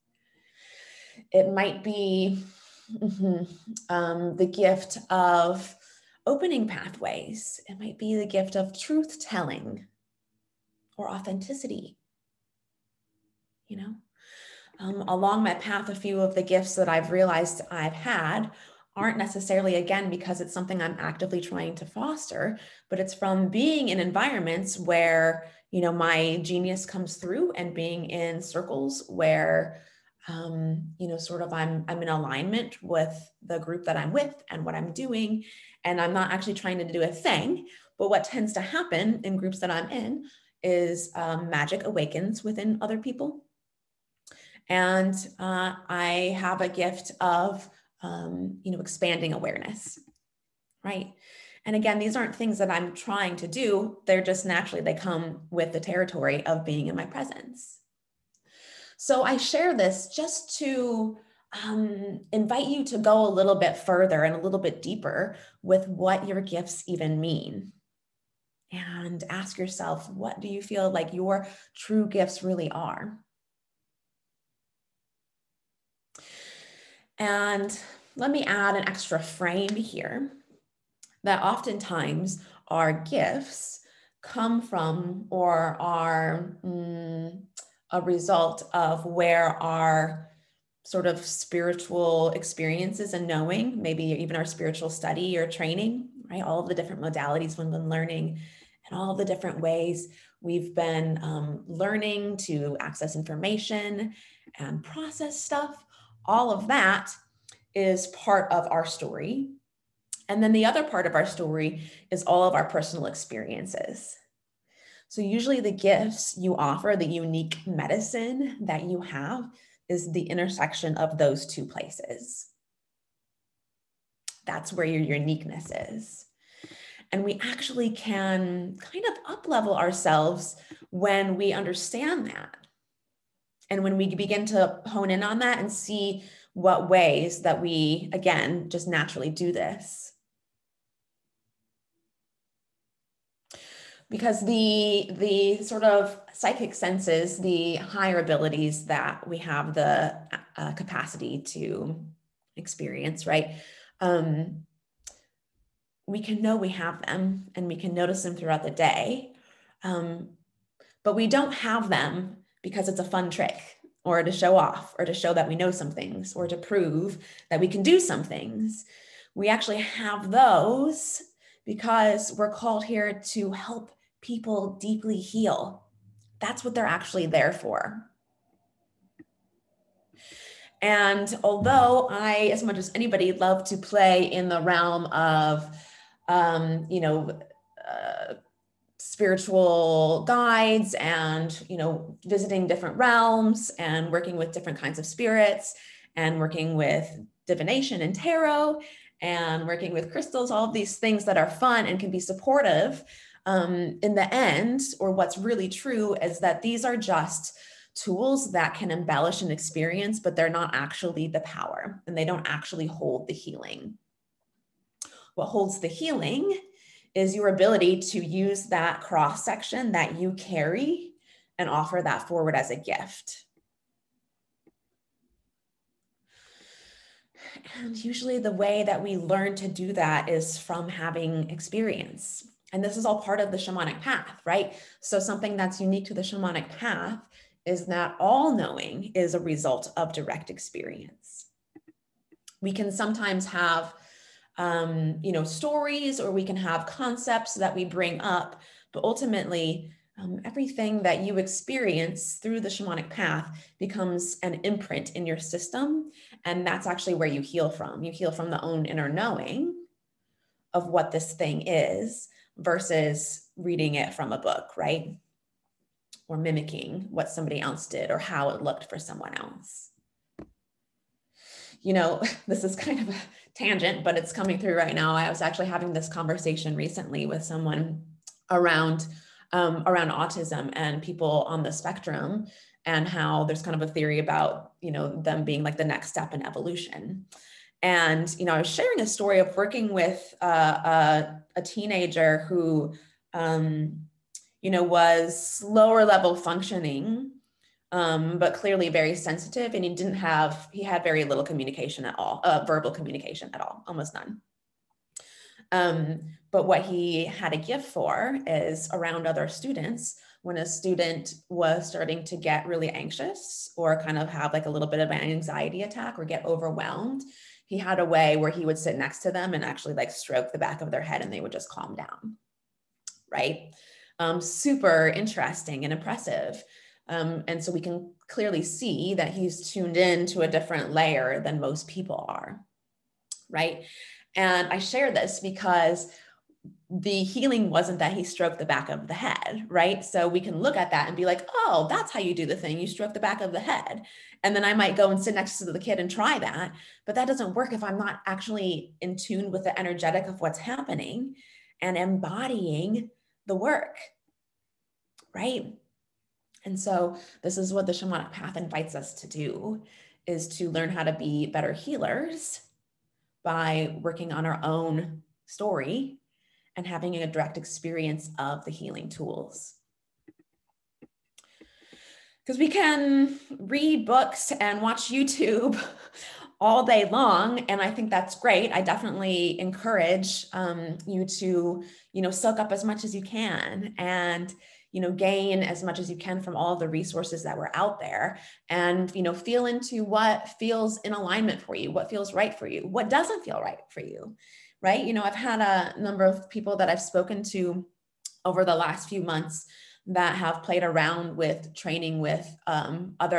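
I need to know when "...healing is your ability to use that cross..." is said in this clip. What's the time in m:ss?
3:35.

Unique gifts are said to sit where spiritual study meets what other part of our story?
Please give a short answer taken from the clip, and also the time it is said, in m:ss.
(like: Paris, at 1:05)
Personal experiences, at 1:52.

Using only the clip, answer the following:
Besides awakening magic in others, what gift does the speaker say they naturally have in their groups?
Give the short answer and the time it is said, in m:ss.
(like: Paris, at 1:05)
Expanding awareness, at 0:48.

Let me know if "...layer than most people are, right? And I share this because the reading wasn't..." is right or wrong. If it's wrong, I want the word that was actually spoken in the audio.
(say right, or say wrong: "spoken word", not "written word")
wrong: "healing", not "reading".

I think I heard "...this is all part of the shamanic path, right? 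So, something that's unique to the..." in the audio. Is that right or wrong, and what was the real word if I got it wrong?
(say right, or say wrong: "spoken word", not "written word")
right.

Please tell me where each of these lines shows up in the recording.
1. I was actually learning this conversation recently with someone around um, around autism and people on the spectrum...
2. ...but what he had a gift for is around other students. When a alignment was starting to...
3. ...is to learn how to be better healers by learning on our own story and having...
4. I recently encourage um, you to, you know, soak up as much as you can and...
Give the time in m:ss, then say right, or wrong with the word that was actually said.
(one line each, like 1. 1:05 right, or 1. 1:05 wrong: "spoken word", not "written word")
1. 4:35 wrong: "having", not "learning"
2. 5:06 wrong: "student", not "alignment"
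3. 6:00 wrong: "working", not "learning"
4. 6:18 wrong: "definitely", not "recently".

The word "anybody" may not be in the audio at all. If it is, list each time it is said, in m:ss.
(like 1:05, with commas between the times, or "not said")
3:02.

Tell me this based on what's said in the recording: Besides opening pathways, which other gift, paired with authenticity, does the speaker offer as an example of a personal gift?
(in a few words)
Truth telling.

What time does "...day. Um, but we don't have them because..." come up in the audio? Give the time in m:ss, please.
2:38.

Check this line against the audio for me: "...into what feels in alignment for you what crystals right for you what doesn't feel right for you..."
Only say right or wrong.
wrong.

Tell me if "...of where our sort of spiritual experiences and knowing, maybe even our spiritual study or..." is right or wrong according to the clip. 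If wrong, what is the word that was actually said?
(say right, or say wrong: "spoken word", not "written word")
right.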